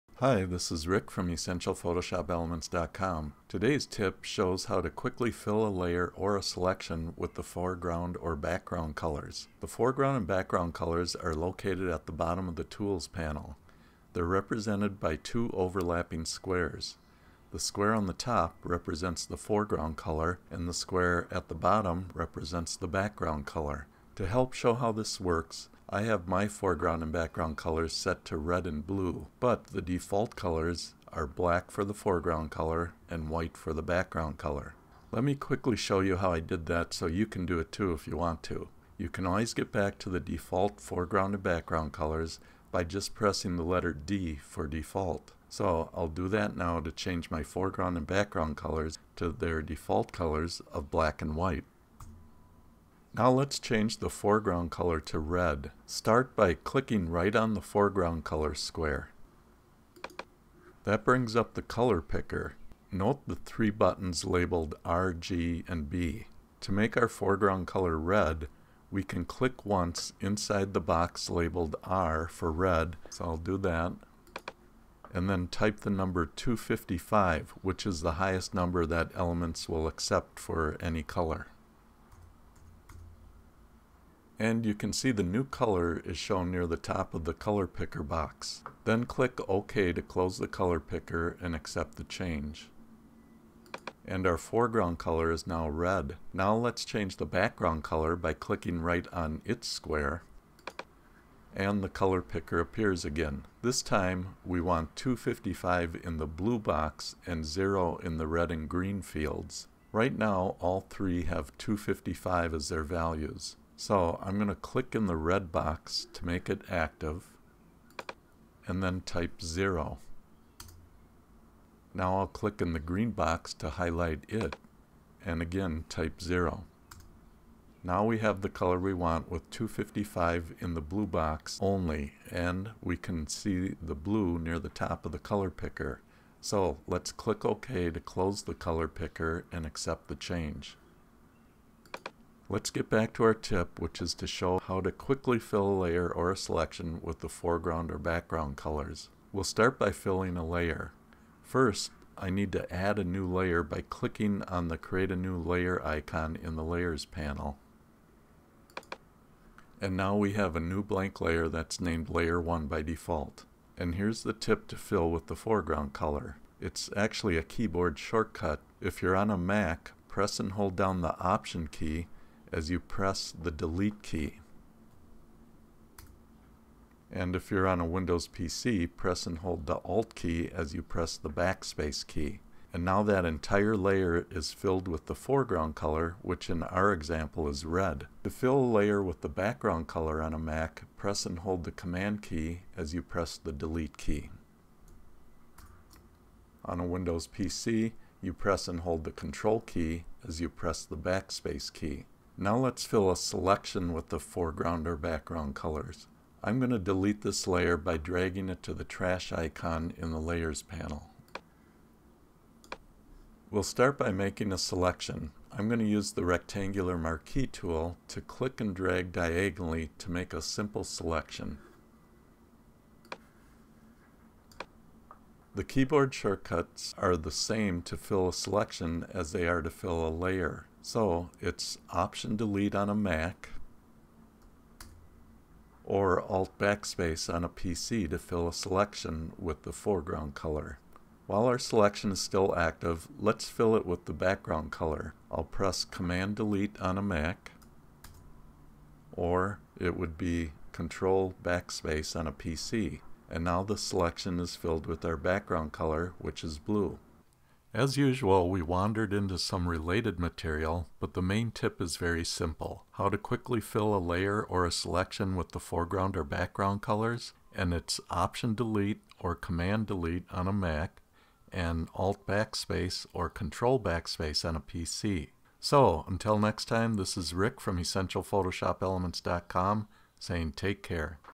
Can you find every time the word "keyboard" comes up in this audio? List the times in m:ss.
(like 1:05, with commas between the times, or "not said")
2:47, 3:45.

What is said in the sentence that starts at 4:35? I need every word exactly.
So, until next time, this is Rick from EssentialPhotoshopElements.com saying take care.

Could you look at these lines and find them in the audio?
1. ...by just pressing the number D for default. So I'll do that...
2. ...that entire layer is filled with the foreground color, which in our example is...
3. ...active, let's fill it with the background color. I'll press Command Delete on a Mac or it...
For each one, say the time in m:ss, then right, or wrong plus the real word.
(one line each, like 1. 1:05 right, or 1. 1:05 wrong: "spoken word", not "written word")
1. 0:42 wrong: "letter", not "number"
2. 3:03 right
3. 4:02 right.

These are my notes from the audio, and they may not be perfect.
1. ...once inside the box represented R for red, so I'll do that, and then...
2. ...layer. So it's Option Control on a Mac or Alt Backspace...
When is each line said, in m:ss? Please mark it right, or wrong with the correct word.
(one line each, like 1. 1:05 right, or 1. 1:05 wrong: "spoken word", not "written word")
1. 1:09 wrong: "labeled", not "represented"
2. 3:50 wrong: "Delete", not "Control".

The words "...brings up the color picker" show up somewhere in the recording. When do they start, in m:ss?
1:01.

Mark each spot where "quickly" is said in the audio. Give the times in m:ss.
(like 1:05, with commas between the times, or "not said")
0:04, 0:35, 2:24, 4:23.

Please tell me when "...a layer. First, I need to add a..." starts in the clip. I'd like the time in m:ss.
2:30.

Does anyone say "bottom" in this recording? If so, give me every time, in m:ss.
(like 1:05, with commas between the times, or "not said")
0:12, 0:21.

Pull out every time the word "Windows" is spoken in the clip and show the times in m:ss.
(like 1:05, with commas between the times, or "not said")
2:57, 3:16.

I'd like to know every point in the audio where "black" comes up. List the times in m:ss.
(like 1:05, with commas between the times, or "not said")
0:31, 0:50.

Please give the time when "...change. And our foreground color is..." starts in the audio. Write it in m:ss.
1:32.